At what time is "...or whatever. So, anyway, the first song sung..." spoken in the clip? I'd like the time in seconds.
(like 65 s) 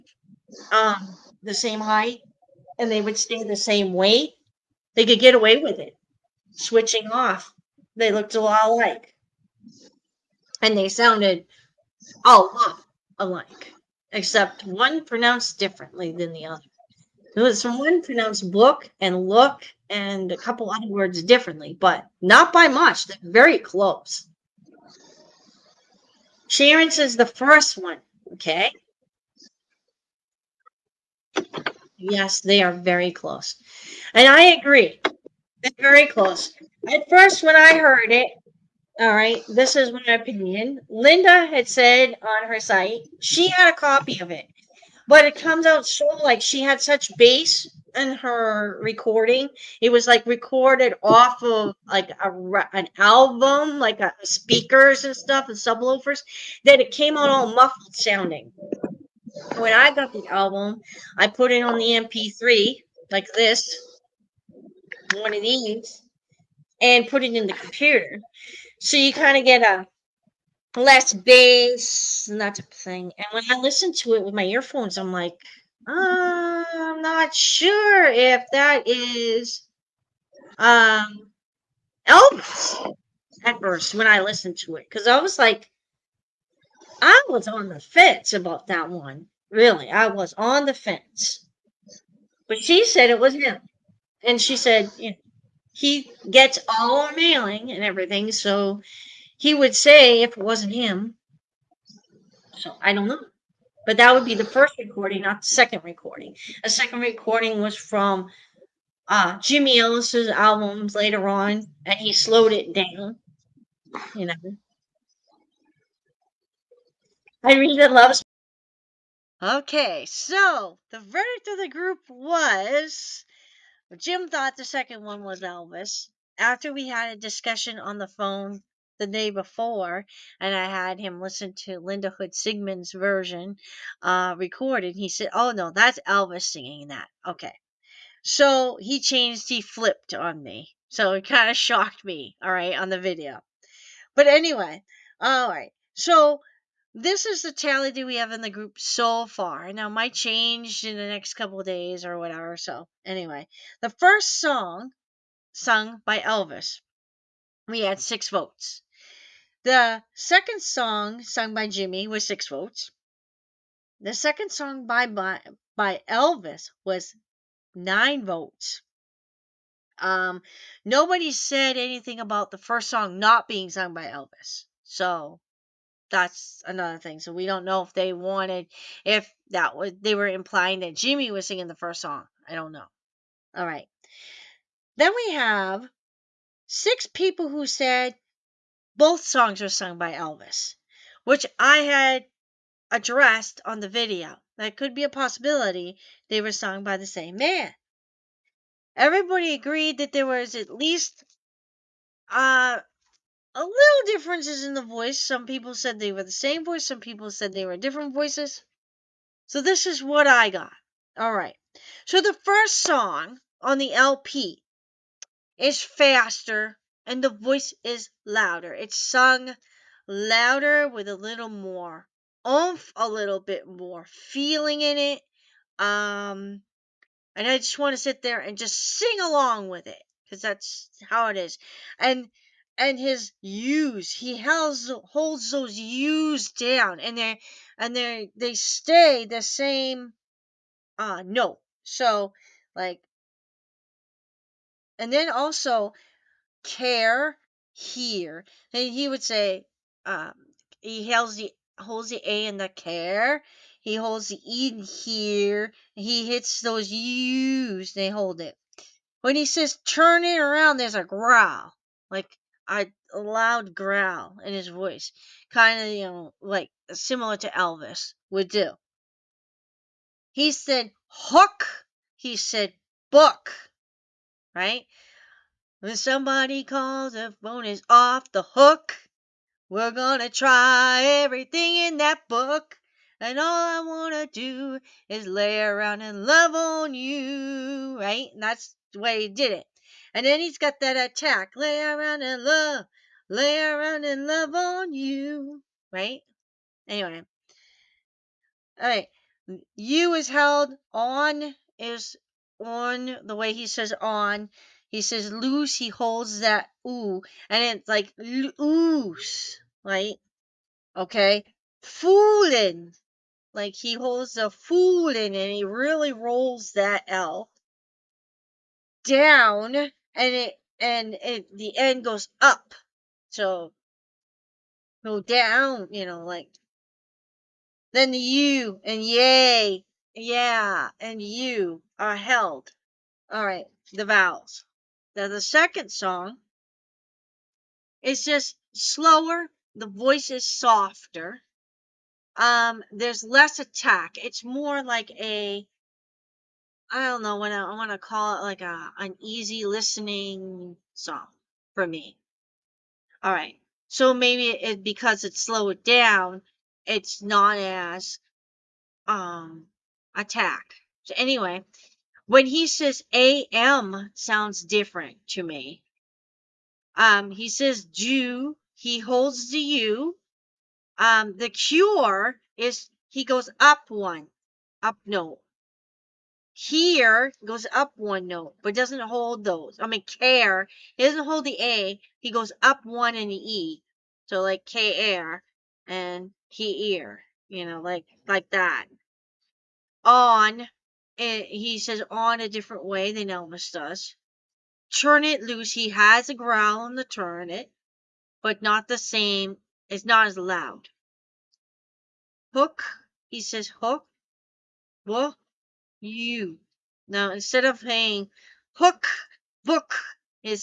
152 s.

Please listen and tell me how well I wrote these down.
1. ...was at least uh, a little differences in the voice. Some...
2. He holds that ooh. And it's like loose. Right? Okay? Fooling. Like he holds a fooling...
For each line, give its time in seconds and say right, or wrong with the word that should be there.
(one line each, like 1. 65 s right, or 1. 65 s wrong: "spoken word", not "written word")
1. 200 s right
2. 305 s right.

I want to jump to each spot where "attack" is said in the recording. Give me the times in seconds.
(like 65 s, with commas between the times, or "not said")
290 s, 343 s, 360 s.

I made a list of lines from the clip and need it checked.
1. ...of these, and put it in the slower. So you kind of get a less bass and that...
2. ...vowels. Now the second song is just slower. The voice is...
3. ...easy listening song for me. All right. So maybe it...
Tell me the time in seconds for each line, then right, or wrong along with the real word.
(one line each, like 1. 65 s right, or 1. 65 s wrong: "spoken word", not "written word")
1. 65 s wrong: "computer", not "slower"
2. 334 s right
3. 349 s right.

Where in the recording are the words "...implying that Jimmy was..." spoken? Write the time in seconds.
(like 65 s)
180 s.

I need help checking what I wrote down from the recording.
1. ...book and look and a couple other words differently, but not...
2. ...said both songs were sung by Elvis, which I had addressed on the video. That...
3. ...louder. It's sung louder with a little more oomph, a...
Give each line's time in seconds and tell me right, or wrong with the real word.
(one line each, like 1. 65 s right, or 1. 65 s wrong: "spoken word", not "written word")
1. 18 s right
2. 187 s right
3. 218 s right.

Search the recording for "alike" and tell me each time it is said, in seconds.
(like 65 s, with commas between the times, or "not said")
8 s, 13 s.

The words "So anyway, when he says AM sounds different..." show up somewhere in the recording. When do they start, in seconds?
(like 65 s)
361 s.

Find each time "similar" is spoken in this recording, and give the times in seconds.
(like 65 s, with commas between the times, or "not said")
266 s.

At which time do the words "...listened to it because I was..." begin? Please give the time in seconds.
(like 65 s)
84 s.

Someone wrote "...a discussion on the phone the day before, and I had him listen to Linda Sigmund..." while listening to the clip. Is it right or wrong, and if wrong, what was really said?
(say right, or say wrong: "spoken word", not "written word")
wrong: "Hood", not "Sigmund".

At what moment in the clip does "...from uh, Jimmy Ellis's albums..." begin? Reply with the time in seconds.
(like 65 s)
107 s.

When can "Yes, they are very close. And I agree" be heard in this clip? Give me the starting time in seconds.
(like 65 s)
31 s.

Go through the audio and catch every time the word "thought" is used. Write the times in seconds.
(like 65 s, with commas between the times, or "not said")
124 s.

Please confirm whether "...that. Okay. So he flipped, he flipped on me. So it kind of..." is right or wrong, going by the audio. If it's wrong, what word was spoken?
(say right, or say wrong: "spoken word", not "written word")
wrong: "changed", not "flipped".